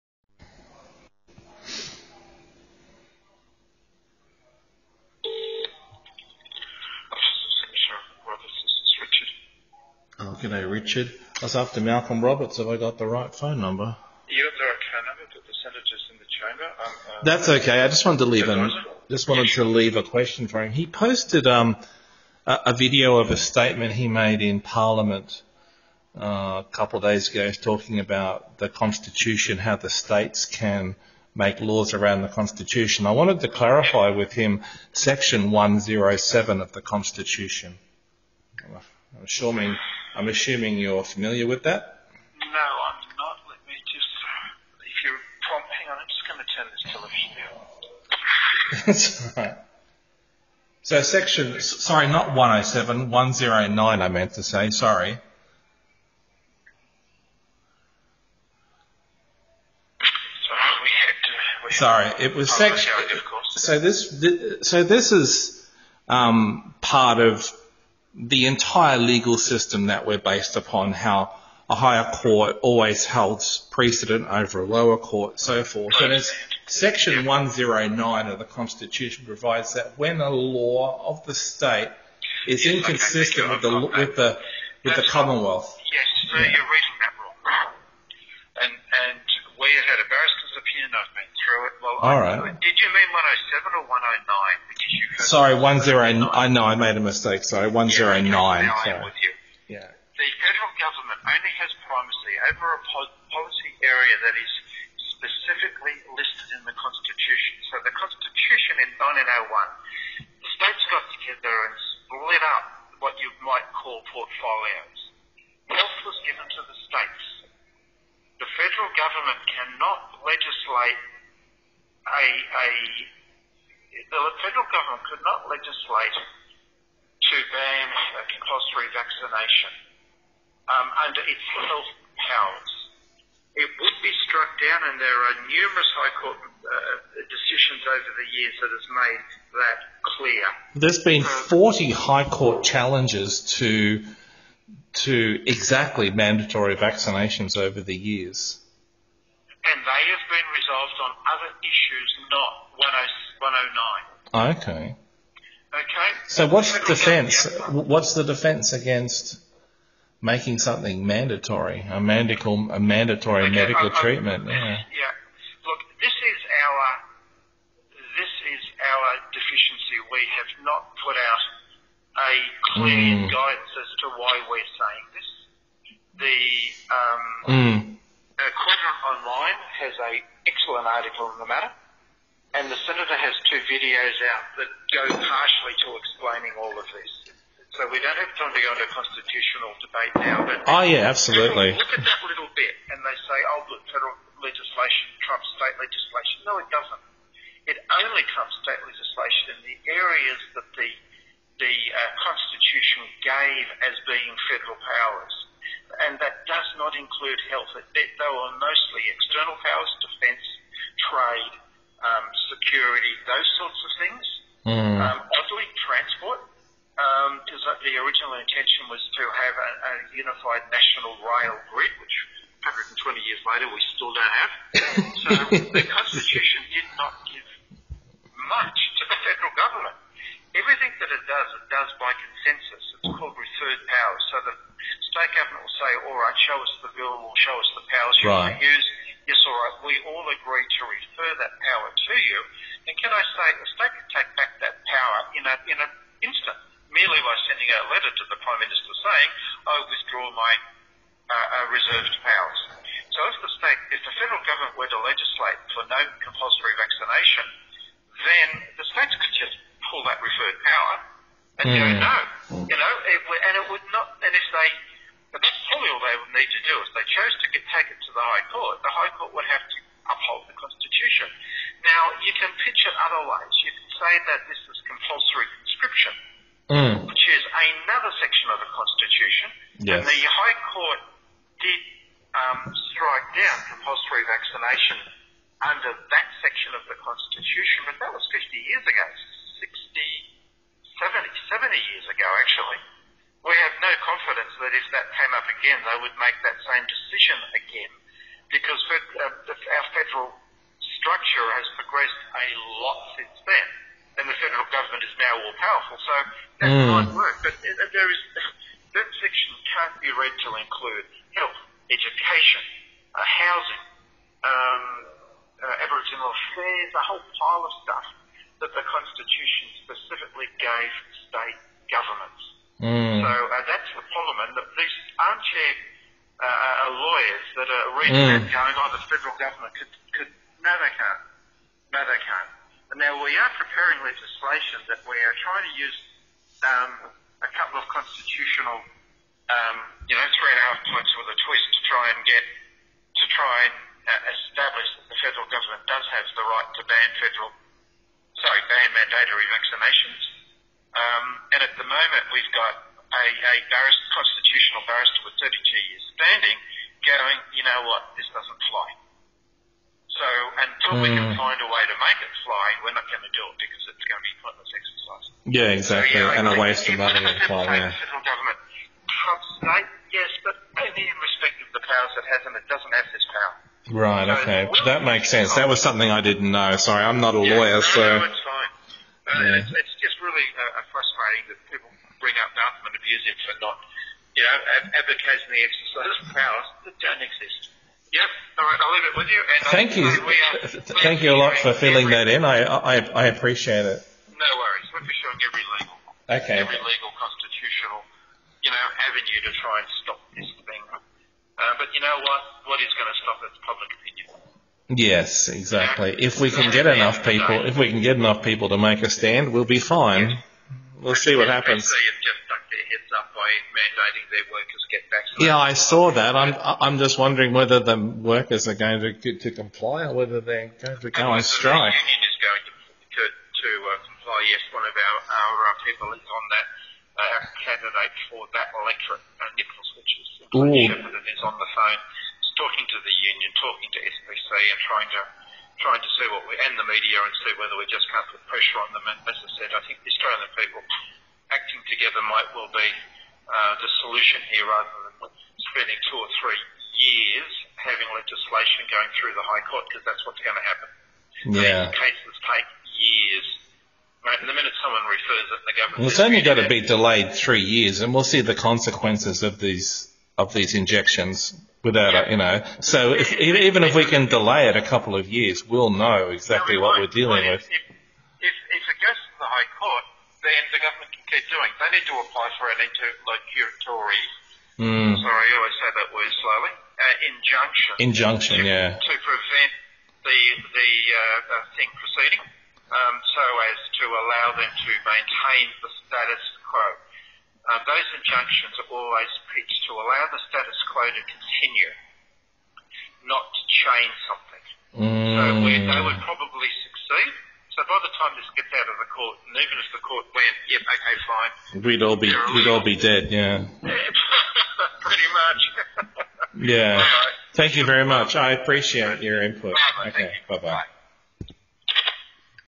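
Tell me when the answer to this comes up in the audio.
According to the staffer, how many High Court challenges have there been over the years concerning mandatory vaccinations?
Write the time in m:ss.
2:21.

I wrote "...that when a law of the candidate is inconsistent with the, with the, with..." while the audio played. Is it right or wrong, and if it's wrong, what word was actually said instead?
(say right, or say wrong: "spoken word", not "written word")
wrong: "state", not "candidate".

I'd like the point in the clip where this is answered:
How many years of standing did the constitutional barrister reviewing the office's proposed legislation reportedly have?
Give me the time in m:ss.
5:55.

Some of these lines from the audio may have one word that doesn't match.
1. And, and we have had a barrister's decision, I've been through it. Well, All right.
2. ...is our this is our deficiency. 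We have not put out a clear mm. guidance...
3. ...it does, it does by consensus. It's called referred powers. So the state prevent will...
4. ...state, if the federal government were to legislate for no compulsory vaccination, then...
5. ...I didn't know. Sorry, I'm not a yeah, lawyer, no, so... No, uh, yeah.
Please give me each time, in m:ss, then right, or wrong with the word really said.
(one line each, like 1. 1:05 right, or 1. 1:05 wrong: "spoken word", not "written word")
1. 1:28 wrong: "opinion", not "decision"
2. 2:46 right
3. 3:51 wrong: "government", not "prevent"
4. 4:13 right
5. 6:16 right.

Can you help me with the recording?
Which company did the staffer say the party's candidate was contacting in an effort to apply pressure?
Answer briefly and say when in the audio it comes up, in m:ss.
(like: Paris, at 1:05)
SPC, at 7:14.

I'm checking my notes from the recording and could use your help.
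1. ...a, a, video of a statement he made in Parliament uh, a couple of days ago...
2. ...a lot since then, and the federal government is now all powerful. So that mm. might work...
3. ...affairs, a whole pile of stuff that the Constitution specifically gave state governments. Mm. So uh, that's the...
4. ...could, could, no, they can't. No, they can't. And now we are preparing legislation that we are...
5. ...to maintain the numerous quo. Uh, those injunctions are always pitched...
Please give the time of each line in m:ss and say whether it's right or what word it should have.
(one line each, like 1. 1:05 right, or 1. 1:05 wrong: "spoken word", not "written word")
1. 0:22 right
2. 5:02 right
3. 5:16 right
4. 5:29 right
5. 8:04 wrong: "status", not "numerous".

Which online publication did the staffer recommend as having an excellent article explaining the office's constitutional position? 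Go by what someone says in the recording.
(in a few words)
Quadrant Online.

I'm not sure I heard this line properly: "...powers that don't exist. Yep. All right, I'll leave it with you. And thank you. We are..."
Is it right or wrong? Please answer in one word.
right.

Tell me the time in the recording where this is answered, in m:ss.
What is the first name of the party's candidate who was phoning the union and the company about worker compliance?
7:09.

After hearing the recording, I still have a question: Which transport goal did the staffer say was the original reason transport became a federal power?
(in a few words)
unified national rail grid.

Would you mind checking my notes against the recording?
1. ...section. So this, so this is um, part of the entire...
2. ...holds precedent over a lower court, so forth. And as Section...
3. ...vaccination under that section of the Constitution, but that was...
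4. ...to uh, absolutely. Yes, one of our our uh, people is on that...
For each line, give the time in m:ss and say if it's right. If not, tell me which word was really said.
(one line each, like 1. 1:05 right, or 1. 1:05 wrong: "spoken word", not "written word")
1. 1:02 right
2. 1:13 right
3. 4:44 right
4. 7:03 wrong: "comply", not "absolutely".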